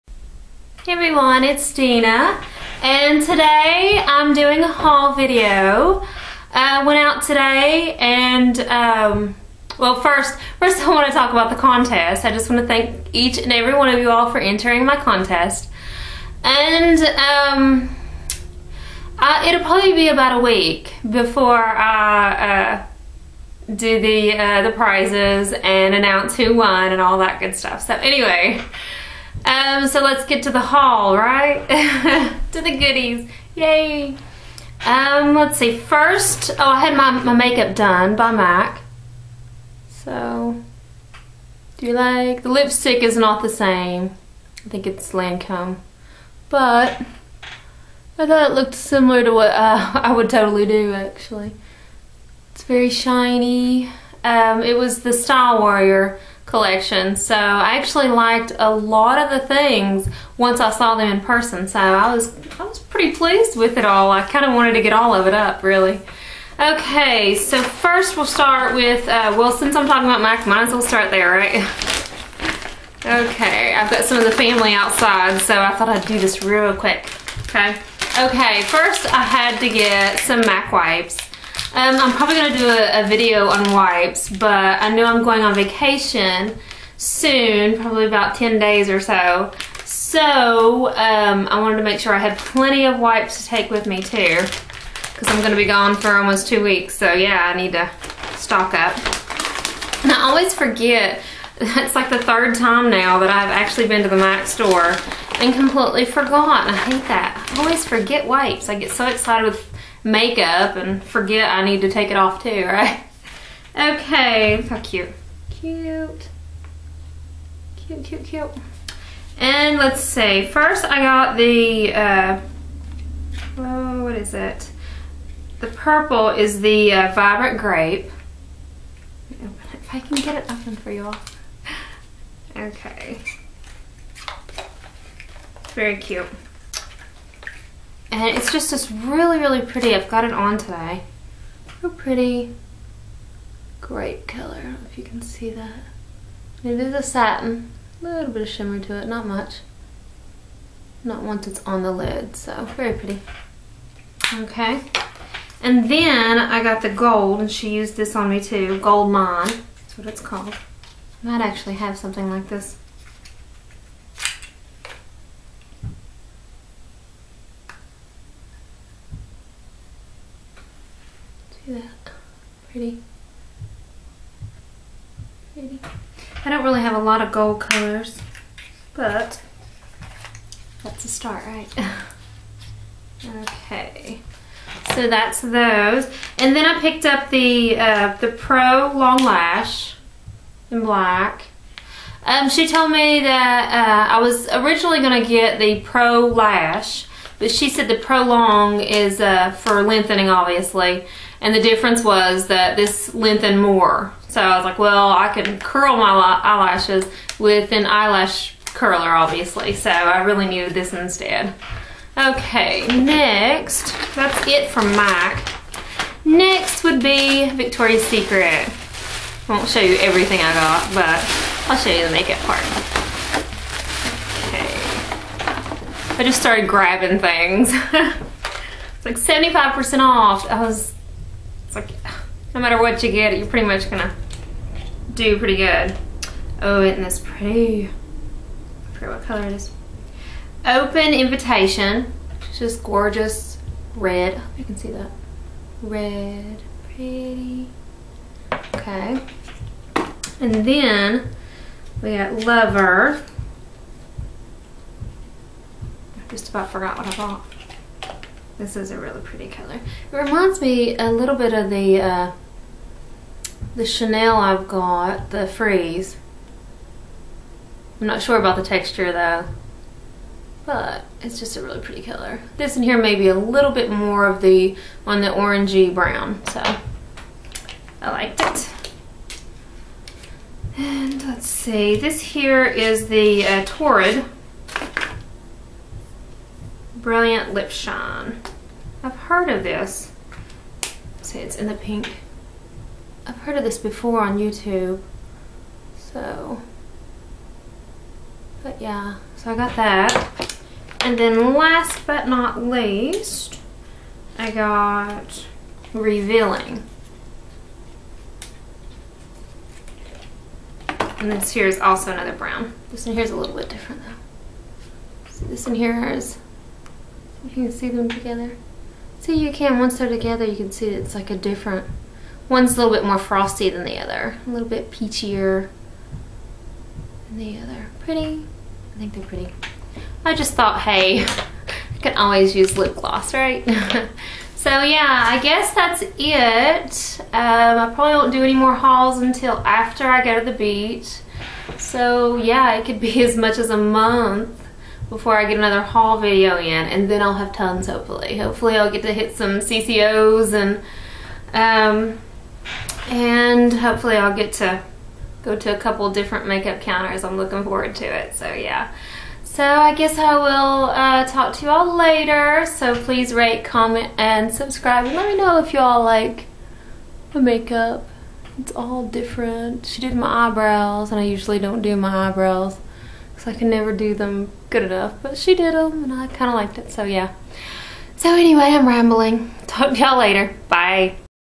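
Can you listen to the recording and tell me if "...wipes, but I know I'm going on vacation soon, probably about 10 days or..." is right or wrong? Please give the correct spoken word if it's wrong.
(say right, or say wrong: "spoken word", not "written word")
right.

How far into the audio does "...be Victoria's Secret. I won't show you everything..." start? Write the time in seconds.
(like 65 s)
217 s.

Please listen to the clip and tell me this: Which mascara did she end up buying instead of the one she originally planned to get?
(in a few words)
Pro Long Lash.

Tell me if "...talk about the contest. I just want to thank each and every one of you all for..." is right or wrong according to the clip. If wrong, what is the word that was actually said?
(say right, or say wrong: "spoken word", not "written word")
right.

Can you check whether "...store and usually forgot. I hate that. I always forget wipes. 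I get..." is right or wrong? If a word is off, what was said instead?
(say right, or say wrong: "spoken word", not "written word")
wrong: "completely", not "usually".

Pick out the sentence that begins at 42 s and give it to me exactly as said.
The lipstick is not the same.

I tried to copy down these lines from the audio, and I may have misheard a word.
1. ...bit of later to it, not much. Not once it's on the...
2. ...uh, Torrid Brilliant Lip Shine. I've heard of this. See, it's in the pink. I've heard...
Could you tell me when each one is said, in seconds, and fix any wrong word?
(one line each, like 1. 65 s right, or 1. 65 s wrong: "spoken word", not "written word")
1. 148 s wrong: "shimmer", not "later"
2. 283 s right.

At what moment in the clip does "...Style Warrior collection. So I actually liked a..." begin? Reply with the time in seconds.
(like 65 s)
55 s.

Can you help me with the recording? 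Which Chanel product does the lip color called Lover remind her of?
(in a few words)
Freeze.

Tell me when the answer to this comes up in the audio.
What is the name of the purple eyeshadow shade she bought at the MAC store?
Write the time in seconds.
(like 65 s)
127 s.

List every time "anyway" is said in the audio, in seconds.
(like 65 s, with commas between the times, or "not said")
27 s, 378 s.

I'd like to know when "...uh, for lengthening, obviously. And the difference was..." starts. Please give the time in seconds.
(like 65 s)
199 s.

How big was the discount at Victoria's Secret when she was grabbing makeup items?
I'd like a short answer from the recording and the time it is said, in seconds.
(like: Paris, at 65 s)
75% off, at 229 s.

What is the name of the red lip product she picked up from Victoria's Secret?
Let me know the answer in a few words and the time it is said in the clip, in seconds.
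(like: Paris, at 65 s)
Open invitation, at 240 s.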